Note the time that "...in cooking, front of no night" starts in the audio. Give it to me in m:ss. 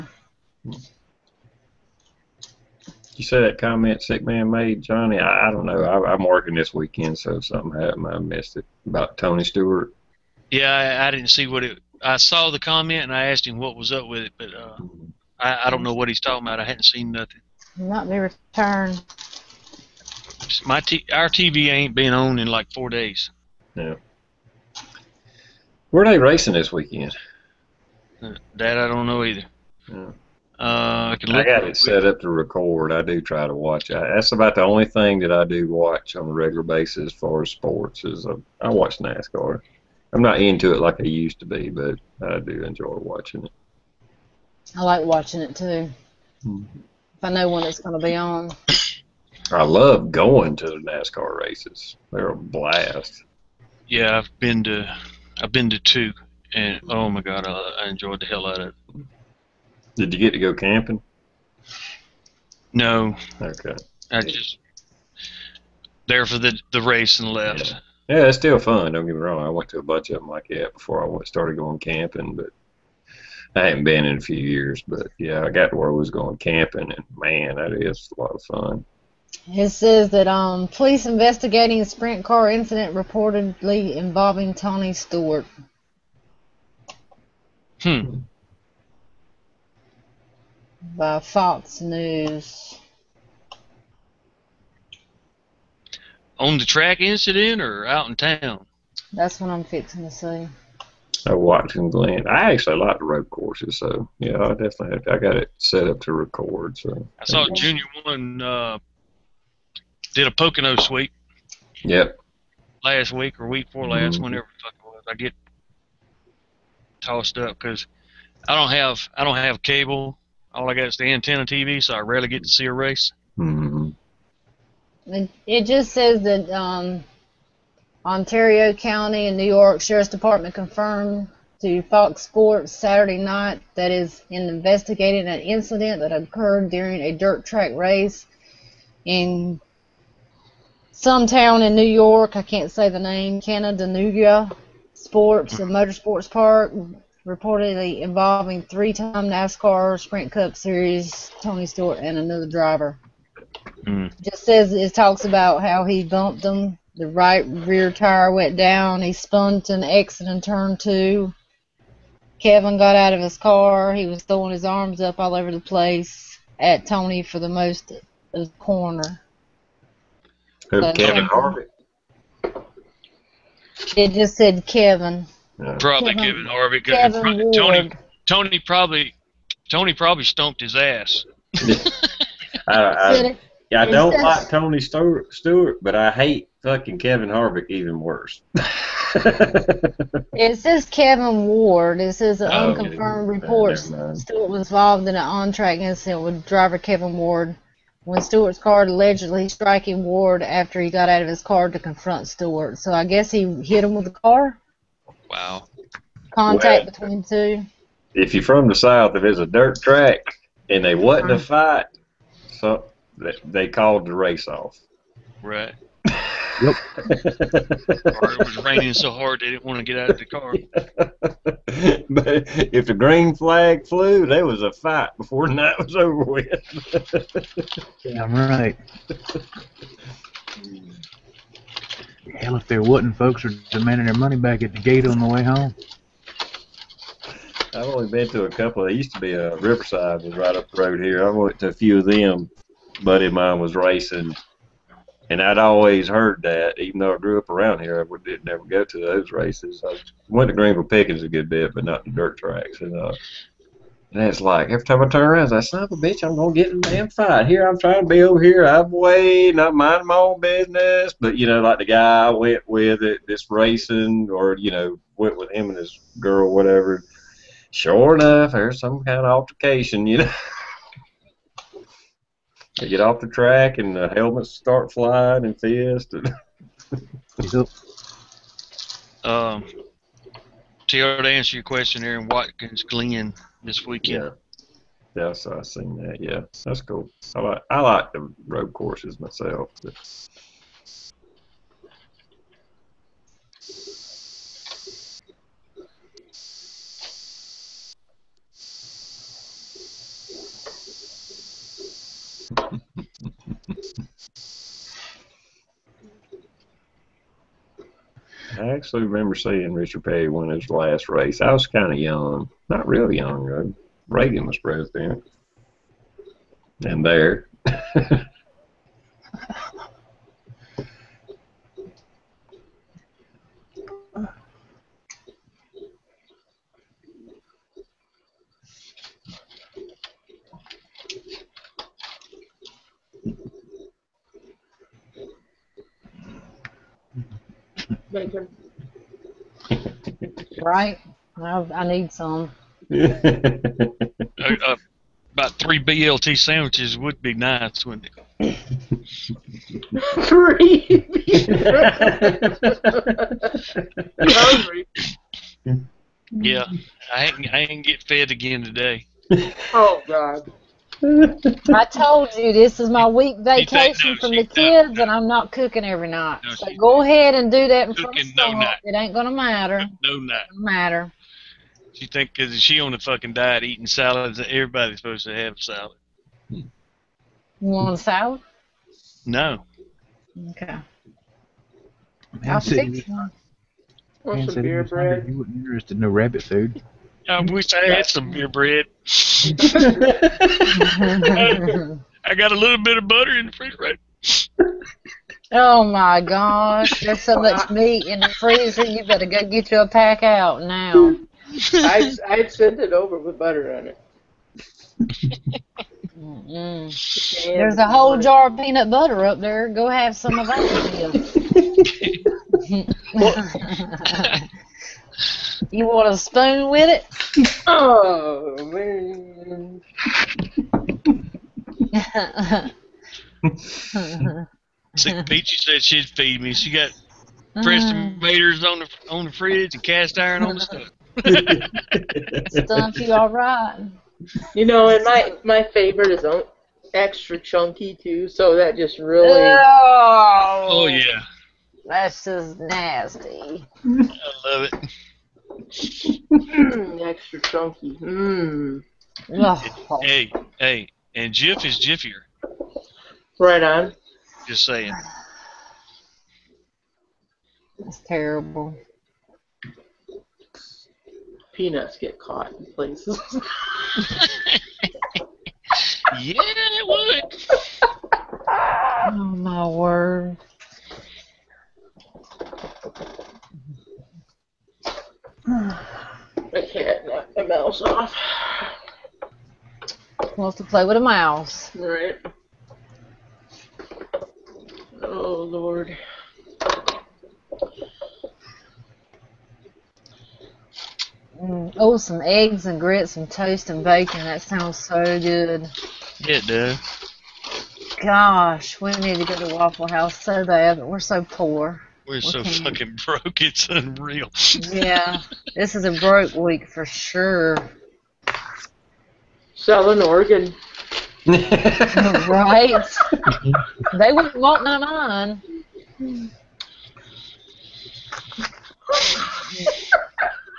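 6:07.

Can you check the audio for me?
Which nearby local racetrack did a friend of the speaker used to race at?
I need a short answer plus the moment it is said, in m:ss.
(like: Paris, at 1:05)
Riverside, at 3:59.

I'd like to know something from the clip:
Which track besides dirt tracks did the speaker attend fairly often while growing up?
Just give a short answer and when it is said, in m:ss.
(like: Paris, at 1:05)
Greenville Pickens, at 4:10.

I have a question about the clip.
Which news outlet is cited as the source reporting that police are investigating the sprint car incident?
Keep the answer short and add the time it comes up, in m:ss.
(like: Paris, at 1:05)
Fox News, at 1:31.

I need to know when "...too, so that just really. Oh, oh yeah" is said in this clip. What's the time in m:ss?
7:17.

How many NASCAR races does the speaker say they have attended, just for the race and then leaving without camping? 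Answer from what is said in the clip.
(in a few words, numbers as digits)
2.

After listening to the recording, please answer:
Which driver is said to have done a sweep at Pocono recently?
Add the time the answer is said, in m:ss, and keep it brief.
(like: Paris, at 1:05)
Junior, at 1:47.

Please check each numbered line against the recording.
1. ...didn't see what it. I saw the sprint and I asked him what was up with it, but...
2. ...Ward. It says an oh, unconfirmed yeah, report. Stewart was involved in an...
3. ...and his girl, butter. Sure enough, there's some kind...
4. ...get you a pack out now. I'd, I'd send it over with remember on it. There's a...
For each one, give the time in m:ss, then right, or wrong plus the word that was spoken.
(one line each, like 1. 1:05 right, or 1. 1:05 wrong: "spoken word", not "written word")
1. 0:11 wrong: "comment", not "sprint"
2. 3:11 right
3. 4:25 wrong: "whatever", not "butter"
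4. 6:39 wrong: "butter", not "remember".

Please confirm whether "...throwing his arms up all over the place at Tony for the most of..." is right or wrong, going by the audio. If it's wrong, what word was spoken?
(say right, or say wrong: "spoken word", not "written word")
right.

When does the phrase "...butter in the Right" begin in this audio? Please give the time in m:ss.
6:33.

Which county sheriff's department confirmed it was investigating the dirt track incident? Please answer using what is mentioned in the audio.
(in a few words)
Ontario County.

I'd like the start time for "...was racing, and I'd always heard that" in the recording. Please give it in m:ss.
4:03.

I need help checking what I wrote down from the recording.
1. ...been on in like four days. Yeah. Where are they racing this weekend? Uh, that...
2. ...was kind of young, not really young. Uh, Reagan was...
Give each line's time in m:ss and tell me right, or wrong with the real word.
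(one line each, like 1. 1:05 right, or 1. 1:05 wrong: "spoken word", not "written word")
1. 0:21 right
2. 5:11 right.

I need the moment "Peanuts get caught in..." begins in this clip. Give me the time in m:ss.
7:41.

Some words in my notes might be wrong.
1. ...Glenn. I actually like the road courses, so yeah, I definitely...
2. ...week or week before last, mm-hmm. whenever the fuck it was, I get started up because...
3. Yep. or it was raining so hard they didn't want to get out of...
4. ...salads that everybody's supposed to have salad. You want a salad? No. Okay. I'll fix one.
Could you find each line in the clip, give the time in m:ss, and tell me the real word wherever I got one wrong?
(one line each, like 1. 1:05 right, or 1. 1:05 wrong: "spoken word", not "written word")
1. 1:41 right
2. 1:53 wrong: "tossed", not "started"
3. 3:36 right
4. 6:13 right.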